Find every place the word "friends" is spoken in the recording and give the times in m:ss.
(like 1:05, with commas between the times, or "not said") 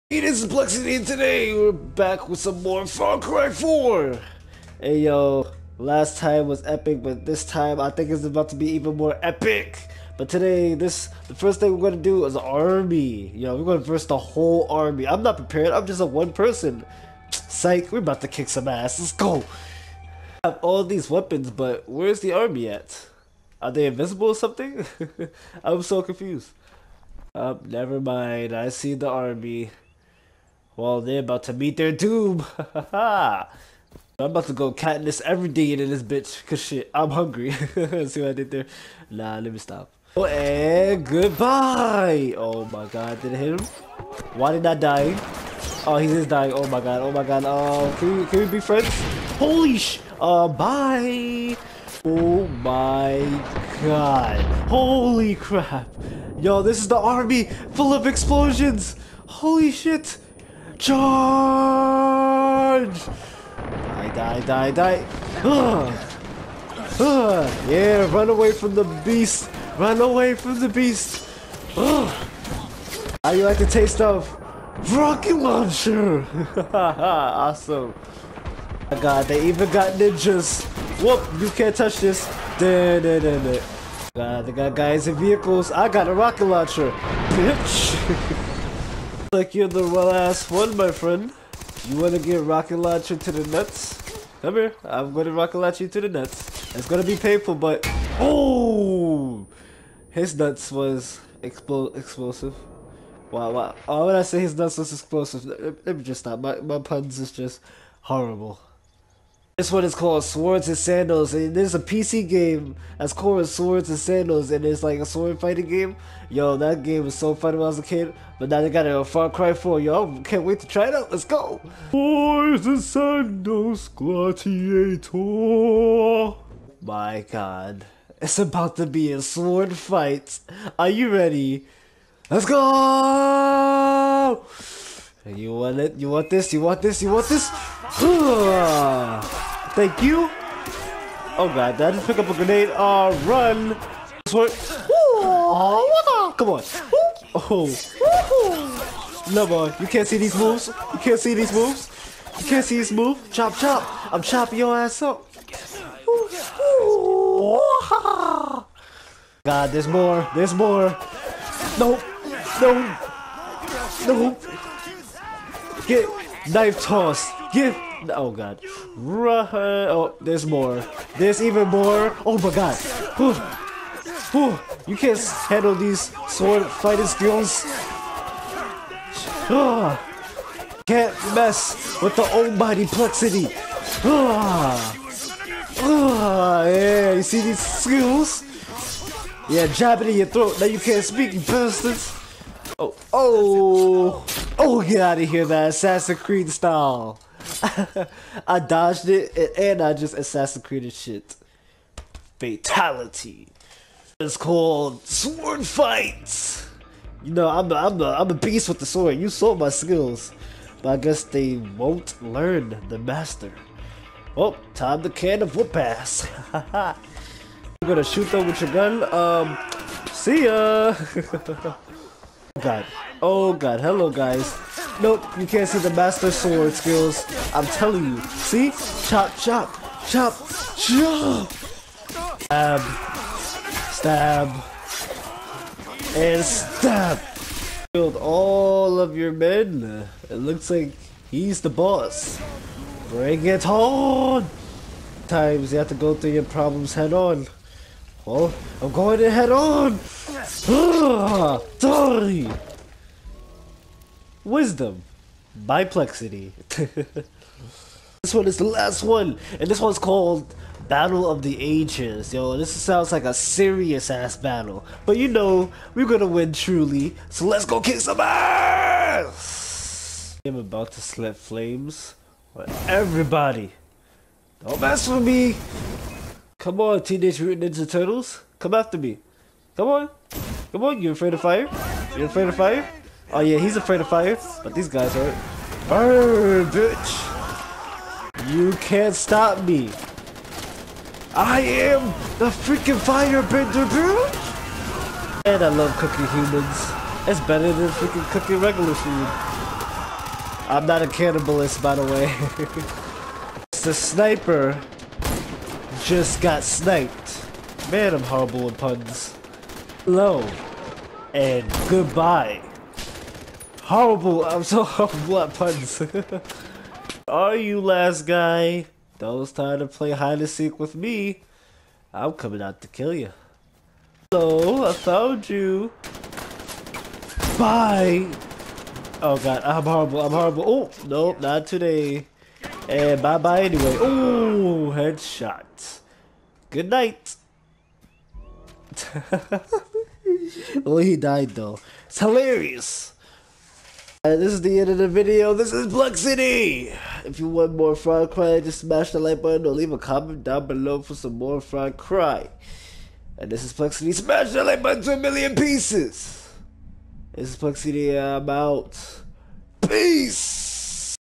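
0:48, 1:30.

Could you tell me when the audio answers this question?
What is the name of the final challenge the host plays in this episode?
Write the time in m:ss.
4:20.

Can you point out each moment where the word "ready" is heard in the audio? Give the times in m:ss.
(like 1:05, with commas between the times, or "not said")
2:11.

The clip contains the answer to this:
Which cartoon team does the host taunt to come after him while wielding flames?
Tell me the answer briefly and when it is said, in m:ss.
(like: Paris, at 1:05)
Teenage Mutant Ninja Turtles, at 4:37.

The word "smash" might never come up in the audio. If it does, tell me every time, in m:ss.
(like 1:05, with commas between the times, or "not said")
5:48, 5:54.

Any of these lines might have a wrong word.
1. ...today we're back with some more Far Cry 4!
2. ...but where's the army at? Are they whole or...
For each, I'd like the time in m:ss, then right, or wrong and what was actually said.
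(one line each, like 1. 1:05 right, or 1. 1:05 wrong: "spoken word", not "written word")
1. 0:01 right
2. 0:21 wrong: "invisible", not "whole".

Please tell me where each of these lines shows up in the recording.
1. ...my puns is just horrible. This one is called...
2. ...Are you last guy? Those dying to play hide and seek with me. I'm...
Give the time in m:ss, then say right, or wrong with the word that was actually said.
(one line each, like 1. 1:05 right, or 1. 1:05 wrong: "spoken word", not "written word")
1. 1:46 right
2. 5:17 wrong: "trying", not "dying".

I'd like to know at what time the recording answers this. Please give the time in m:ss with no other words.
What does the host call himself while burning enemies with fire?
4:52.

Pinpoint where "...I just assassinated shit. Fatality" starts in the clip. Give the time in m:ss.
3:19.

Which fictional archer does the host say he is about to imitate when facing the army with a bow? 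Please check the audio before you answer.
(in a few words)
Katniss Everdeen.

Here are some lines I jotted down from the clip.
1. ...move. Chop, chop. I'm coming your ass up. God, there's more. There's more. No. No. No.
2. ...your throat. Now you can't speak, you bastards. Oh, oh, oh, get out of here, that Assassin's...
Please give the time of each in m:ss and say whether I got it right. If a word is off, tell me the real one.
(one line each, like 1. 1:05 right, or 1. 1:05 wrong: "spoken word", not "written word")
1. 2:32 wrong: "chopping", not "coming"
2. 3:10 right.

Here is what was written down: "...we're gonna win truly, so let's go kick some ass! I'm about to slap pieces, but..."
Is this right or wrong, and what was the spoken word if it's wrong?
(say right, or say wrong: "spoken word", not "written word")
wrong: "flames", not "pieces".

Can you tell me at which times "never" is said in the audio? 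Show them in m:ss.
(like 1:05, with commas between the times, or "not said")
0:27.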